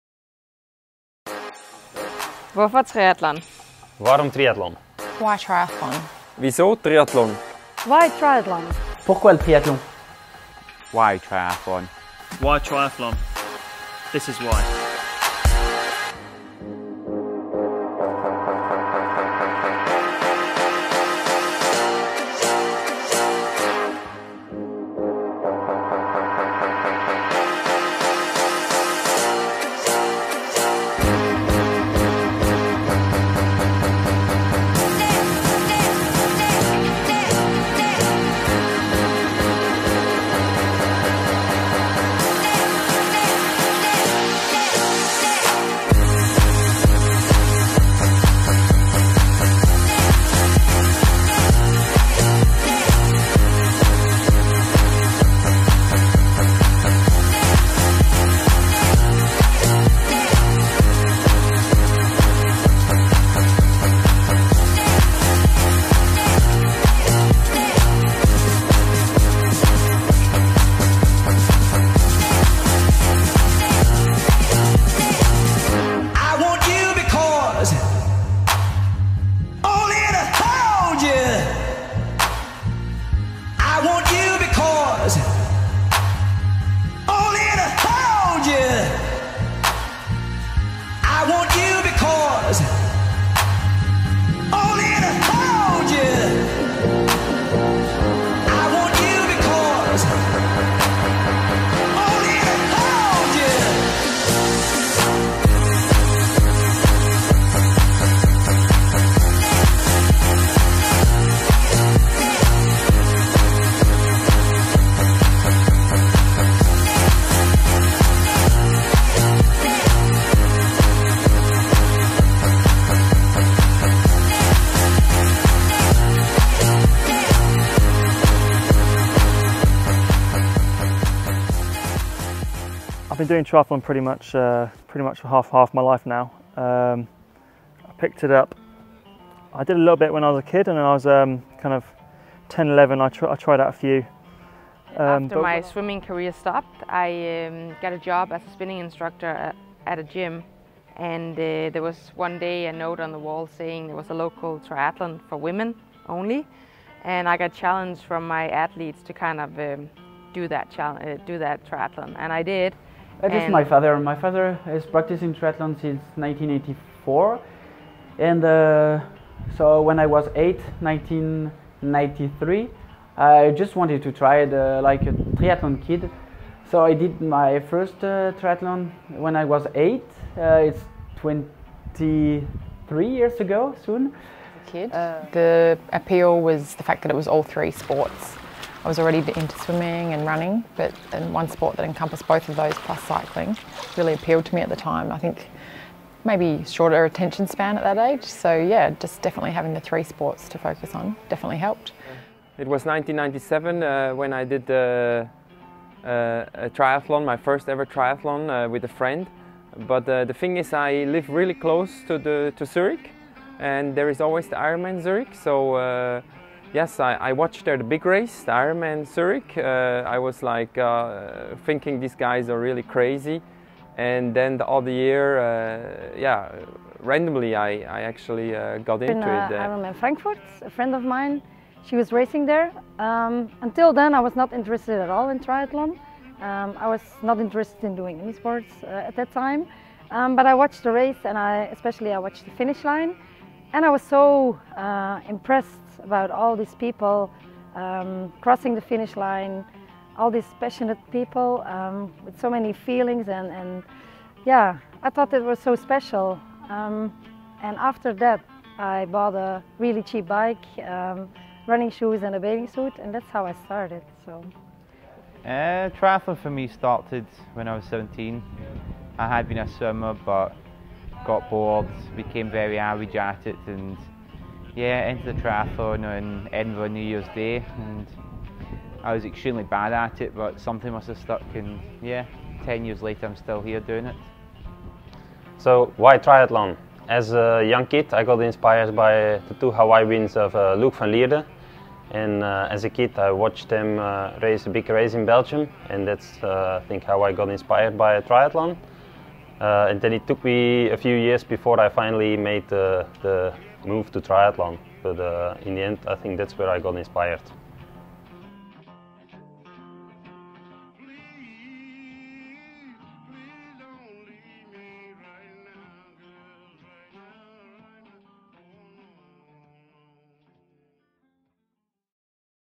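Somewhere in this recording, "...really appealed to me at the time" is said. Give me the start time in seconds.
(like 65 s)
193 s.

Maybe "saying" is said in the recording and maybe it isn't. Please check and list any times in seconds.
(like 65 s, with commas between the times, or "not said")
153 s.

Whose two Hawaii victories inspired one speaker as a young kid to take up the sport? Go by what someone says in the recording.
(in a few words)
Luc van Lierde.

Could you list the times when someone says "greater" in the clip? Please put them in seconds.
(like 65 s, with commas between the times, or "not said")
not said.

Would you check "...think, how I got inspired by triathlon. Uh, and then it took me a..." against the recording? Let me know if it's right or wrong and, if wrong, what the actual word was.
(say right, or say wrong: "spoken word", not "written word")
right.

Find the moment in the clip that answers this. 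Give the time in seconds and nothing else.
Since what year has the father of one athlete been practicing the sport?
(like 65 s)
166 s.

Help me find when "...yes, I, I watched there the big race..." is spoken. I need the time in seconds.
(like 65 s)
216 s.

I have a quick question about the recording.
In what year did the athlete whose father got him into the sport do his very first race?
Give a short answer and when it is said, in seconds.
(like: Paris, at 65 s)
1993, at 170 s.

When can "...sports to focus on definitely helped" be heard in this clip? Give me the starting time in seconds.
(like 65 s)
200 s.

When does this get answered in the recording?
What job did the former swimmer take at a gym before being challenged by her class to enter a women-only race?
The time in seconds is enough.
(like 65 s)
148 s.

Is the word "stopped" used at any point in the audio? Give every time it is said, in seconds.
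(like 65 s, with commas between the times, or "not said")
146 s.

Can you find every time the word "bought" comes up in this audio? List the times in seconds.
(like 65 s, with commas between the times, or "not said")
259 s.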